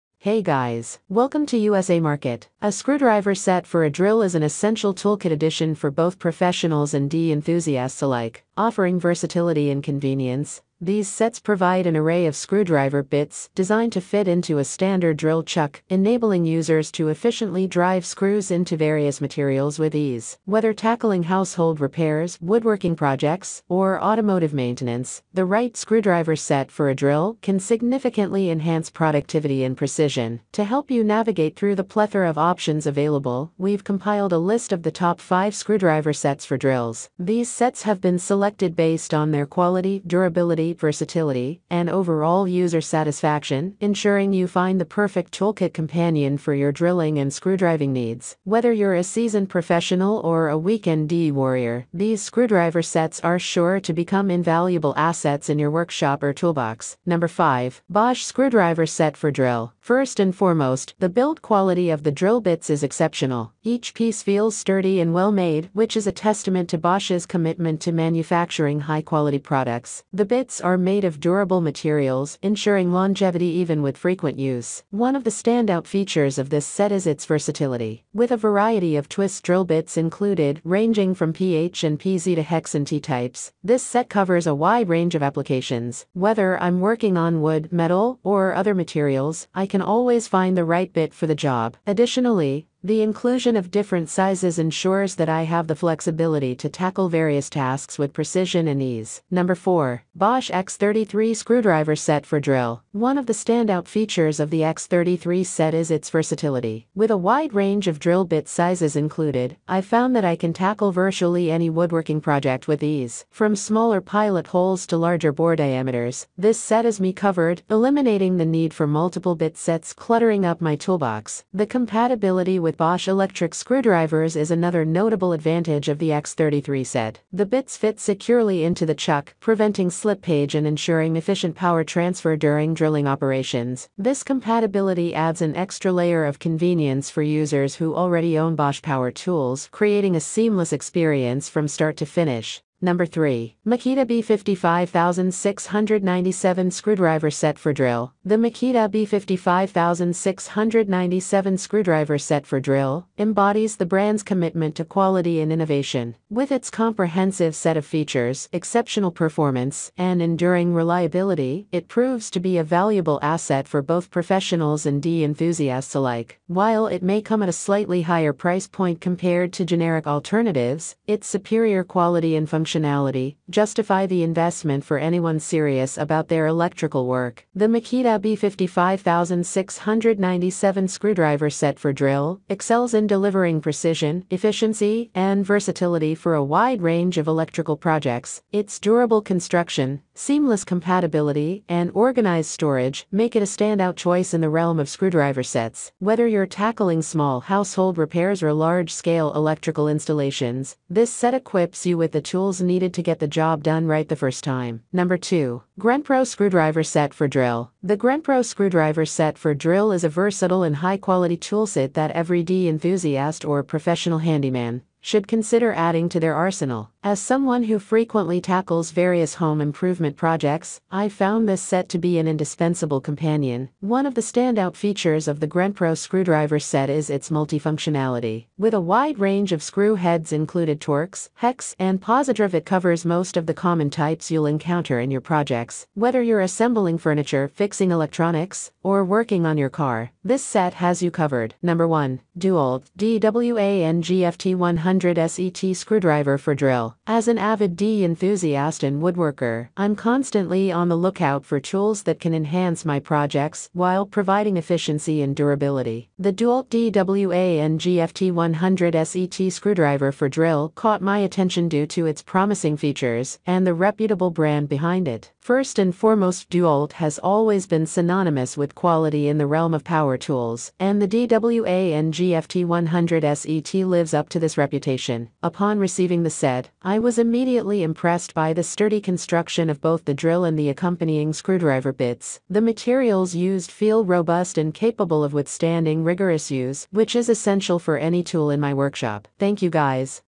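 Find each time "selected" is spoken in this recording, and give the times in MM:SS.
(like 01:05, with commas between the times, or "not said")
00:38.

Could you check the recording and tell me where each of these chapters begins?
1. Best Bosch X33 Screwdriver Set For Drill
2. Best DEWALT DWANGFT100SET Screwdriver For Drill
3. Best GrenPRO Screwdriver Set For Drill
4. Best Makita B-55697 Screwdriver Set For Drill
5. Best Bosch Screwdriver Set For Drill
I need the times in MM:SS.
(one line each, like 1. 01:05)
1. 01:39
2. 04:01
3. 03:24
4. 02:22
5. 00:56.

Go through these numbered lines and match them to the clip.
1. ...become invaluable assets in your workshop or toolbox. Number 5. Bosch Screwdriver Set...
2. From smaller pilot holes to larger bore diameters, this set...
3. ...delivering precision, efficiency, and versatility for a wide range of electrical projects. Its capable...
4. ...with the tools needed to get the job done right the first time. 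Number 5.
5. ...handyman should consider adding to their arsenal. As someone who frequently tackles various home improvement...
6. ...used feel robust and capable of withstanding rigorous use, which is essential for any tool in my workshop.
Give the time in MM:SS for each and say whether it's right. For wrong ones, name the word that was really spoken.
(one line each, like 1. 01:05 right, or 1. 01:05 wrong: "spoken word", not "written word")
1. 00:53 right
2. 01:53 right
3. 03:03 wrong: "durable", not "capable"
4. 03:21 wrong: "2", not "5"
5. 03:34 right
6. 04:43 right.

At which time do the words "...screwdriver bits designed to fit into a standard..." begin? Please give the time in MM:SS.
00:12.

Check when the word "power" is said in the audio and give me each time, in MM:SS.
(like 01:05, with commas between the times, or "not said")
02:11, 02:18, 04:29.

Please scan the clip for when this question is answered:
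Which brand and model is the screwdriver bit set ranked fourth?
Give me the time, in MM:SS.
01:40.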